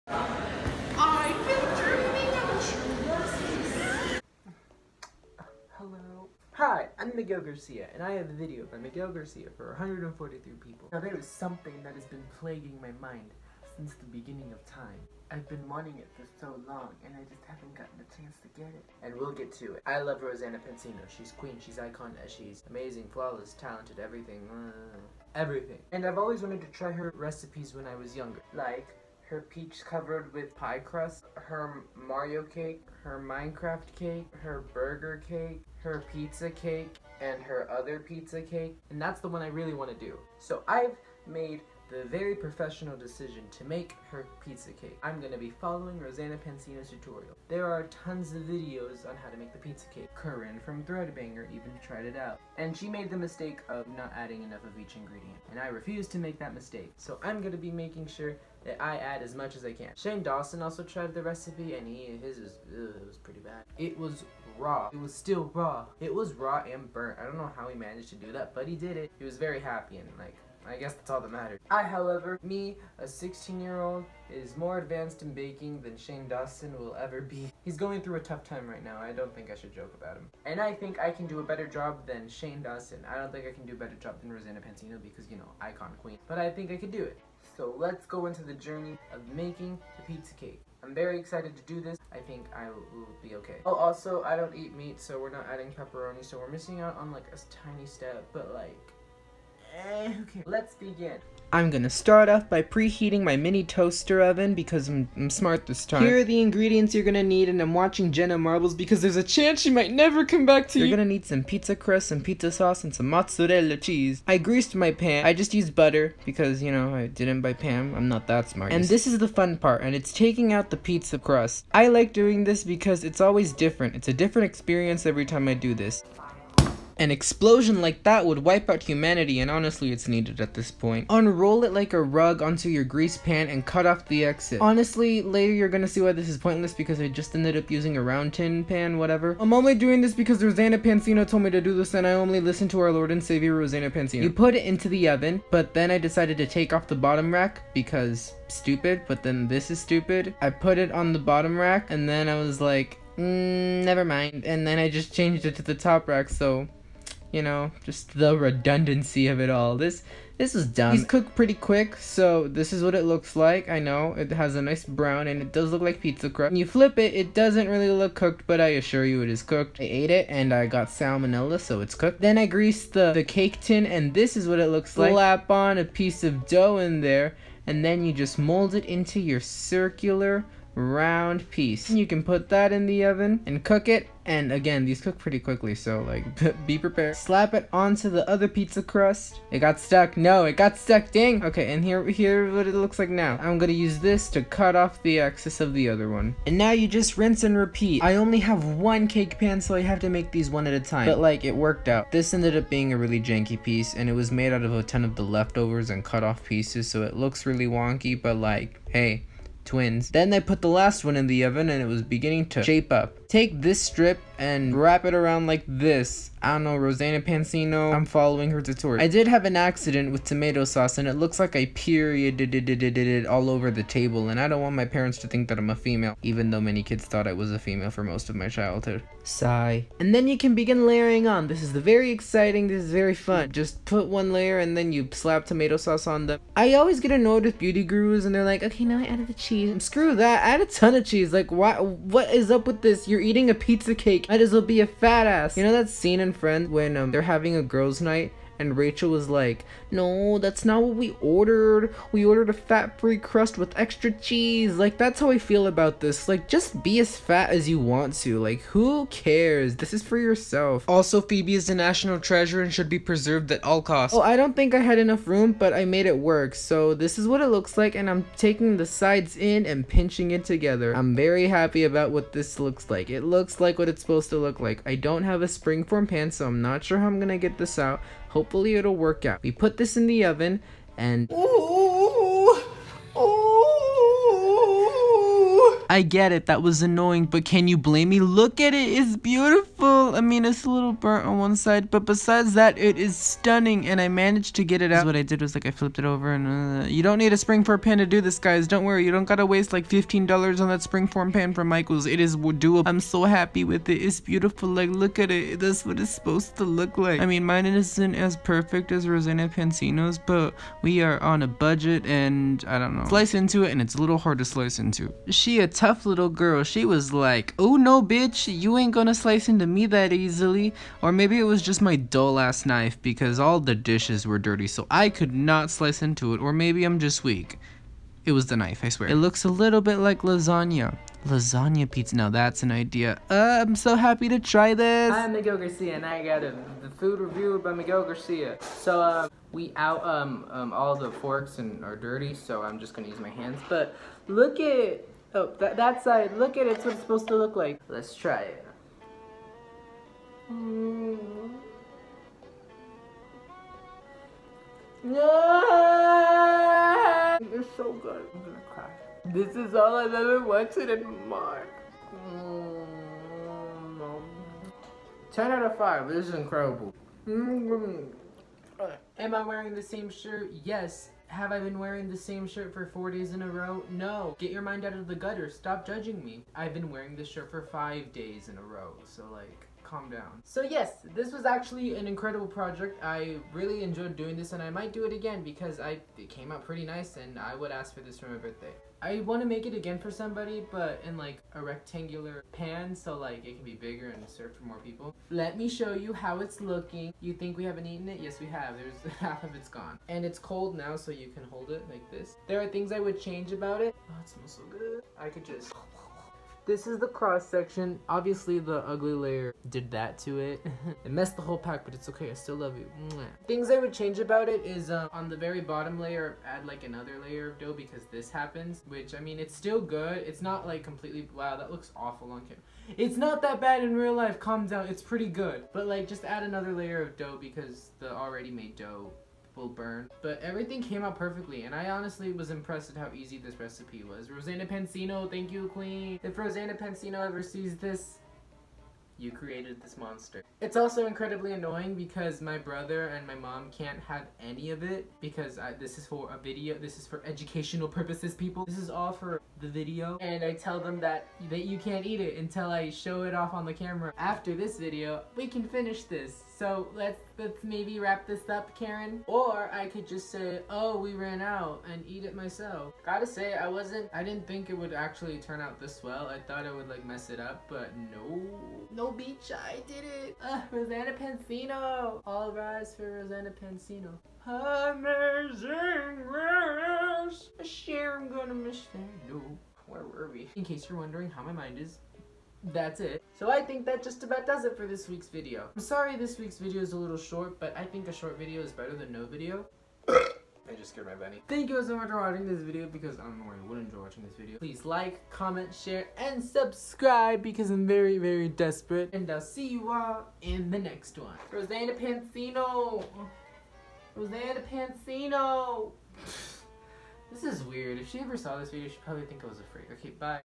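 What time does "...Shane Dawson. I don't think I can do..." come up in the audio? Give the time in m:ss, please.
1:22.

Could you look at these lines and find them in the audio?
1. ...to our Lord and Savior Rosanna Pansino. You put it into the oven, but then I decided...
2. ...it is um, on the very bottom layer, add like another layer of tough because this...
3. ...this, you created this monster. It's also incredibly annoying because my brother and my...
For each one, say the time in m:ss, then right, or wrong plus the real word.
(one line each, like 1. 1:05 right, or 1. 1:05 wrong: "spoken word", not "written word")
1. 2:22 right
2. 6:54 wrong: "dough", not "tough"
3. 7:17 right.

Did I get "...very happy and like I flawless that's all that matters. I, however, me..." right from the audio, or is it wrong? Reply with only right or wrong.
wrong.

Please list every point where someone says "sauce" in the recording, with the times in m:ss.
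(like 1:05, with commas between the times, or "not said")
1:52, 3:40, 3:55.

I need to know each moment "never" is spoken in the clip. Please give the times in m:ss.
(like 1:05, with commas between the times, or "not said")
1:49, 2:33.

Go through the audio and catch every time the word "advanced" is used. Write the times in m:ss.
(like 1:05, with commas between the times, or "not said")
1:14.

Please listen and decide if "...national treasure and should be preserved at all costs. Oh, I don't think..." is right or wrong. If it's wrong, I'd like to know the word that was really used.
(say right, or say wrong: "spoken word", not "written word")
right.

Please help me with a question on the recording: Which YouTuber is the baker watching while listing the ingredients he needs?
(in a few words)
Jenna Marbles.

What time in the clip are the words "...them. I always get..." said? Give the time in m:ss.
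3:56.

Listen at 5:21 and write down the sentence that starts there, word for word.
Or maybe it was just my dull ass knife because all the dishes were dirty, so I could not slice into it.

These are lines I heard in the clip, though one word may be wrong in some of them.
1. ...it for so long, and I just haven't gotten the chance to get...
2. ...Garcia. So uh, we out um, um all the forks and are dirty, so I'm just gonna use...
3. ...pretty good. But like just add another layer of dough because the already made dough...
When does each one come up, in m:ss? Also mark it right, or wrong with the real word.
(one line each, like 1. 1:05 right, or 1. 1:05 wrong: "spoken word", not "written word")
1. 0:15 right
2. 5:38 right
3. 7:05 right.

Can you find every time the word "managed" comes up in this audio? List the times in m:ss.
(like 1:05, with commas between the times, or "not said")
1:07, 4:54.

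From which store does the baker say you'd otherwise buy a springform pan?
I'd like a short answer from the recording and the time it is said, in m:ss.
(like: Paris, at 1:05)
Michael's, at 5:01.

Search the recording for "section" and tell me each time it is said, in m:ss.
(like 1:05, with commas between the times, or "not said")
6:47.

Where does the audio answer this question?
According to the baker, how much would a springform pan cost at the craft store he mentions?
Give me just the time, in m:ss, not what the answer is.
4:59.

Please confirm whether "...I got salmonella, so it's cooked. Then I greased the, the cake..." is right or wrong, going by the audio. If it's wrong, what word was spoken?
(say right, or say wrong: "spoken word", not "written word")
right.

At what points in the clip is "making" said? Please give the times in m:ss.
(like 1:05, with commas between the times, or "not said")
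0:57, 1:29.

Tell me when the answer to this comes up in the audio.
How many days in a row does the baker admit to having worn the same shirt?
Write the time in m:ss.
6:17.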